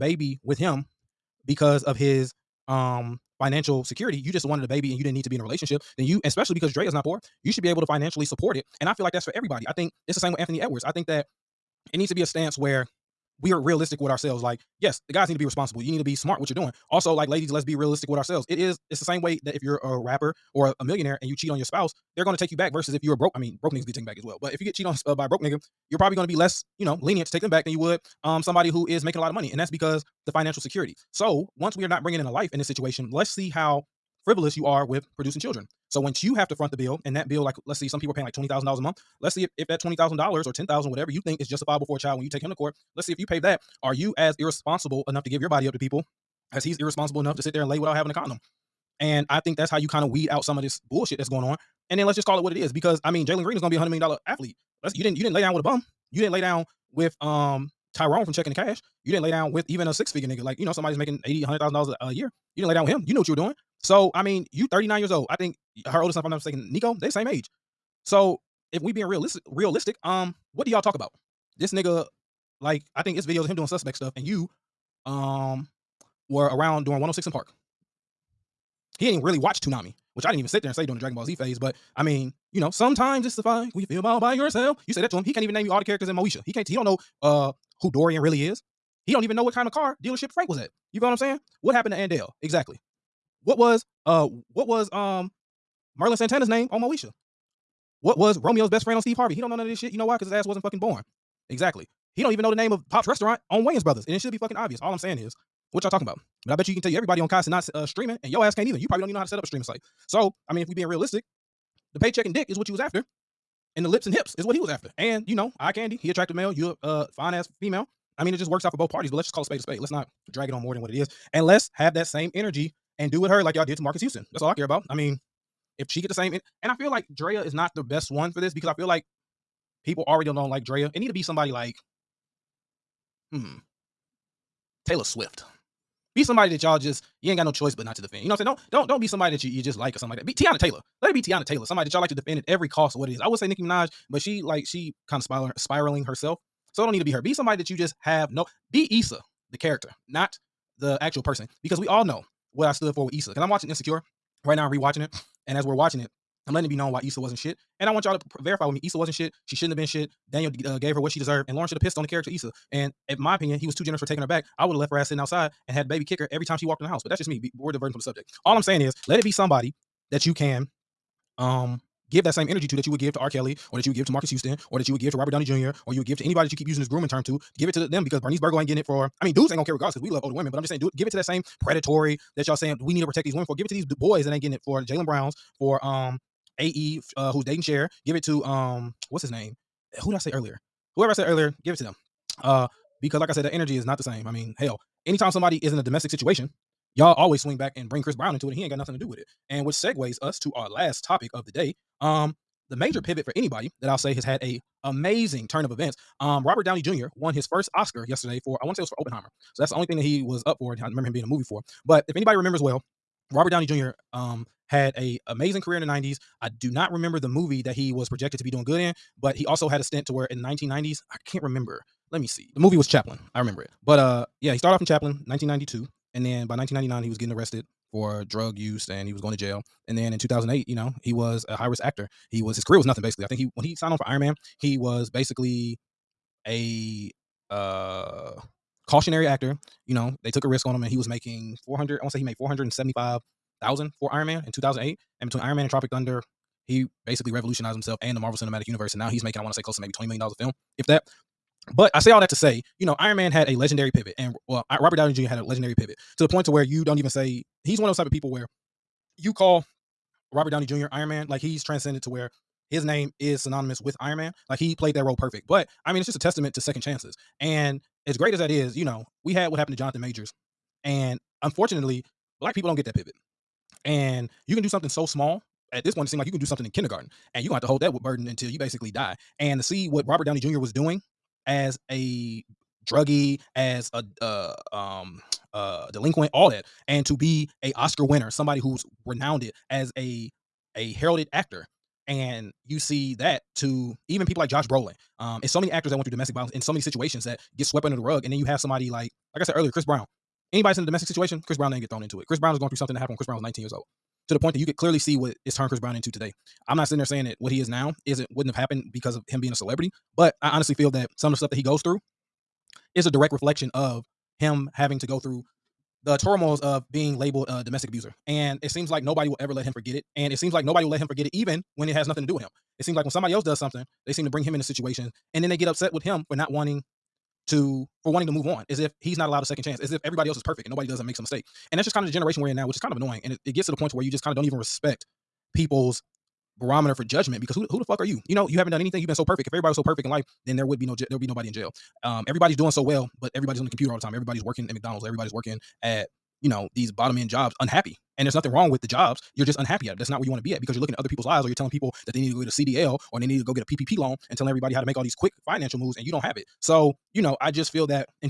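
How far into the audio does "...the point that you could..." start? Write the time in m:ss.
5:04.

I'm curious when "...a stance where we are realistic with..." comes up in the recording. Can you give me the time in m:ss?
0:12.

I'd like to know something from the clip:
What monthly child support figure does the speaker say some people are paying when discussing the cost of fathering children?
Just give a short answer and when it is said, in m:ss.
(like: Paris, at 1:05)
$20,000, at 0:38.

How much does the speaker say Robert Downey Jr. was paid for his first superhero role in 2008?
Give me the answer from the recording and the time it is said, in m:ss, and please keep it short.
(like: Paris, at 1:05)
$475,000, at 4:02.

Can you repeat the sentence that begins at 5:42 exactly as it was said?
Um, everybody's doing so well but everybody's on the computer all the time.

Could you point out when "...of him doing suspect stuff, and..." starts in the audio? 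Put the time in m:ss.
1:13.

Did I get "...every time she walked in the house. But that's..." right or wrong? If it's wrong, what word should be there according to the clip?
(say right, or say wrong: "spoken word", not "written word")
right.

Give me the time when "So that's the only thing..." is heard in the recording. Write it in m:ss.
3:29.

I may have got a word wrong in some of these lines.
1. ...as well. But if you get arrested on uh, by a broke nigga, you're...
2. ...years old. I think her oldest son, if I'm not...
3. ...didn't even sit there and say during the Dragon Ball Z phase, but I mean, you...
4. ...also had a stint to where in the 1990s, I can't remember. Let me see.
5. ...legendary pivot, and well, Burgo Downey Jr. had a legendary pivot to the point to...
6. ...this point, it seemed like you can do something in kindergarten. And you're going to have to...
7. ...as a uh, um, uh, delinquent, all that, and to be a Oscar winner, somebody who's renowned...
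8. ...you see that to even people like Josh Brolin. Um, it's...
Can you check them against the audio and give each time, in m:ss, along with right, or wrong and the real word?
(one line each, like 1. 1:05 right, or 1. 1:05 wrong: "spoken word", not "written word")
1. 0:24 wrong: "cheated", not "arrested"
2. 1:04 right
3. 1:20 right
4. 3:39 right
5. 4:13 wrong: "Robert", not "Burgo"
6. 4:35 right
7. 4:43 right
8. 4:52 right.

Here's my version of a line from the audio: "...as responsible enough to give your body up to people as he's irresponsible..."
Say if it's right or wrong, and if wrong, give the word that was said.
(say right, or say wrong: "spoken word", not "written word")
wrong: "irresponsible", not "responsible".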